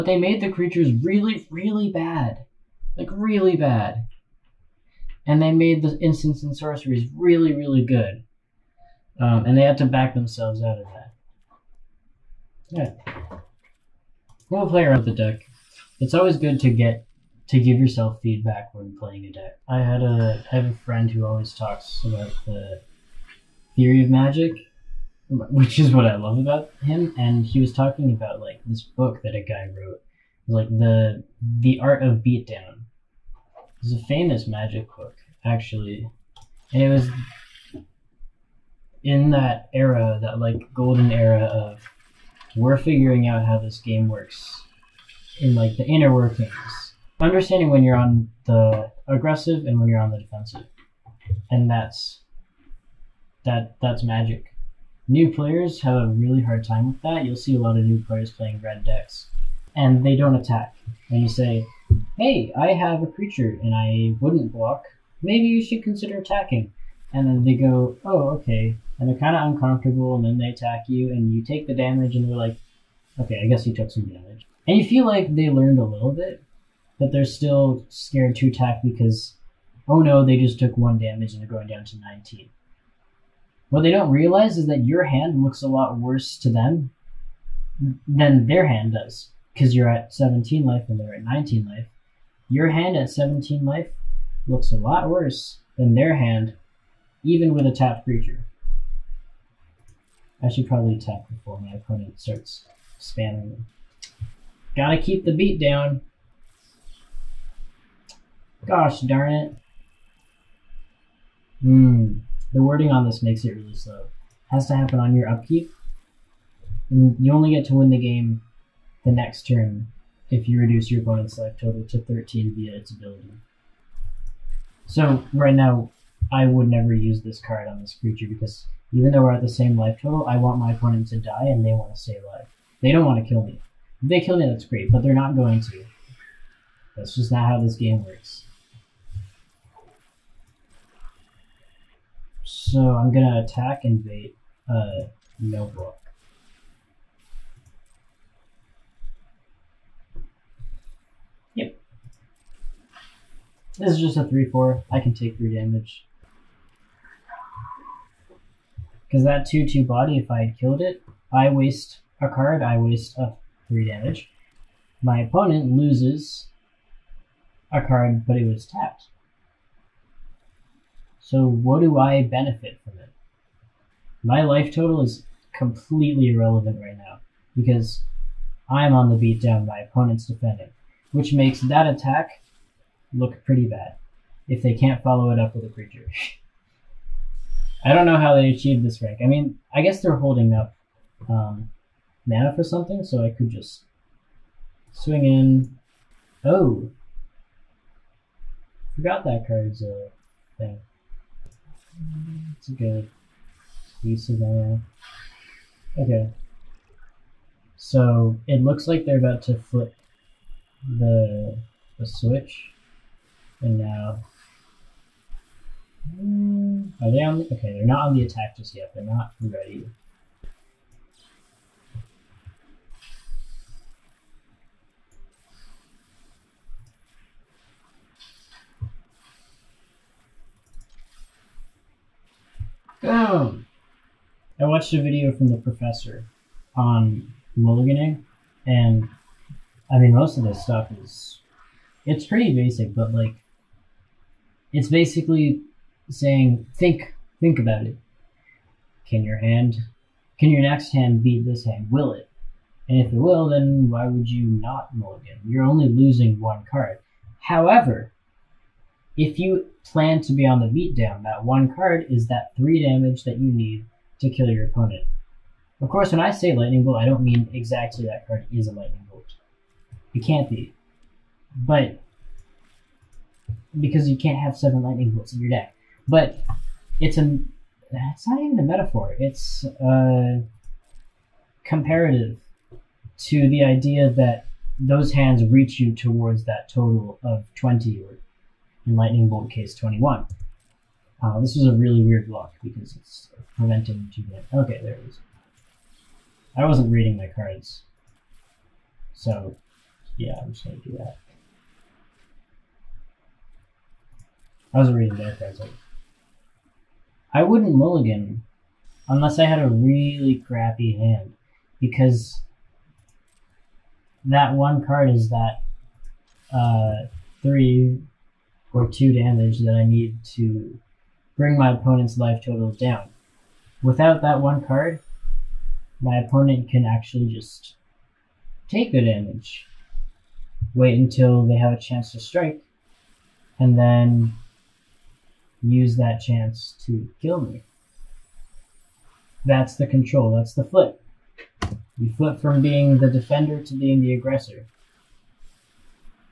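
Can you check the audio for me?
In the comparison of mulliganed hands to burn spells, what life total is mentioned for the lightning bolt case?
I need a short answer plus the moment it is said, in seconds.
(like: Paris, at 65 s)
21, at 289 s.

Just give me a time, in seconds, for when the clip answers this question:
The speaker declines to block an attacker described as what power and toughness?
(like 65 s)
154 s.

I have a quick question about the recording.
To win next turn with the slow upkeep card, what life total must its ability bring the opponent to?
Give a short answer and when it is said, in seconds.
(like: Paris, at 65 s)
13, at 121 s.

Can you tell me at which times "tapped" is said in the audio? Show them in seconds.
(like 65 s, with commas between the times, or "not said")
97 s, 168 s.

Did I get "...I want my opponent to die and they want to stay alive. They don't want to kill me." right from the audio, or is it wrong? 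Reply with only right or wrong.
right.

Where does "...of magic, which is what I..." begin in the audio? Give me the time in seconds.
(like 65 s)
24 s.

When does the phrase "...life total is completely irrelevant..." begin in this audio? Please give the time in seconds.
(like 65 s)
174 s.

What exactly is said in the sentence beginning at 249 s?
Can your hand, can your next hand beat this hand?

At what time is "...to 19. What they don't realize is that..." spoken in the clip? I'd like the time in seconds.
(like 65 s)
81 s.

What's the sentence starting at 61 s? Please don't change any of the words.
And you say, hey, I have a creature and I wouldn't block.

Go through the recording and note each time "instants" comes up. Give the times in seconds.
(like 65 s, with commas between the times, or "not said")
5 s.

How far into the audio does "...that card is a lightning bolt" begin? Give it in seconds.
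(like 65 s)
268 s.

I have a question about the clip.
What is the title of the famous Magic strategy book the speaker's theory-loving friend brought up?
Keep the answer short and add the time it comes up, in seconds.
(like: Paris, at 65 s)
The Art of Beatdown, at 31 s.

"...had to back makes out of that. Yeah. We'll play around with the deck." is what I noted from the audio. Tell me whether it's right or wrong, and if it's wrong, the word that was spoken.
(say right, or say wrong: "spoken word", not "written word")
wrong: "themselves", not "makes".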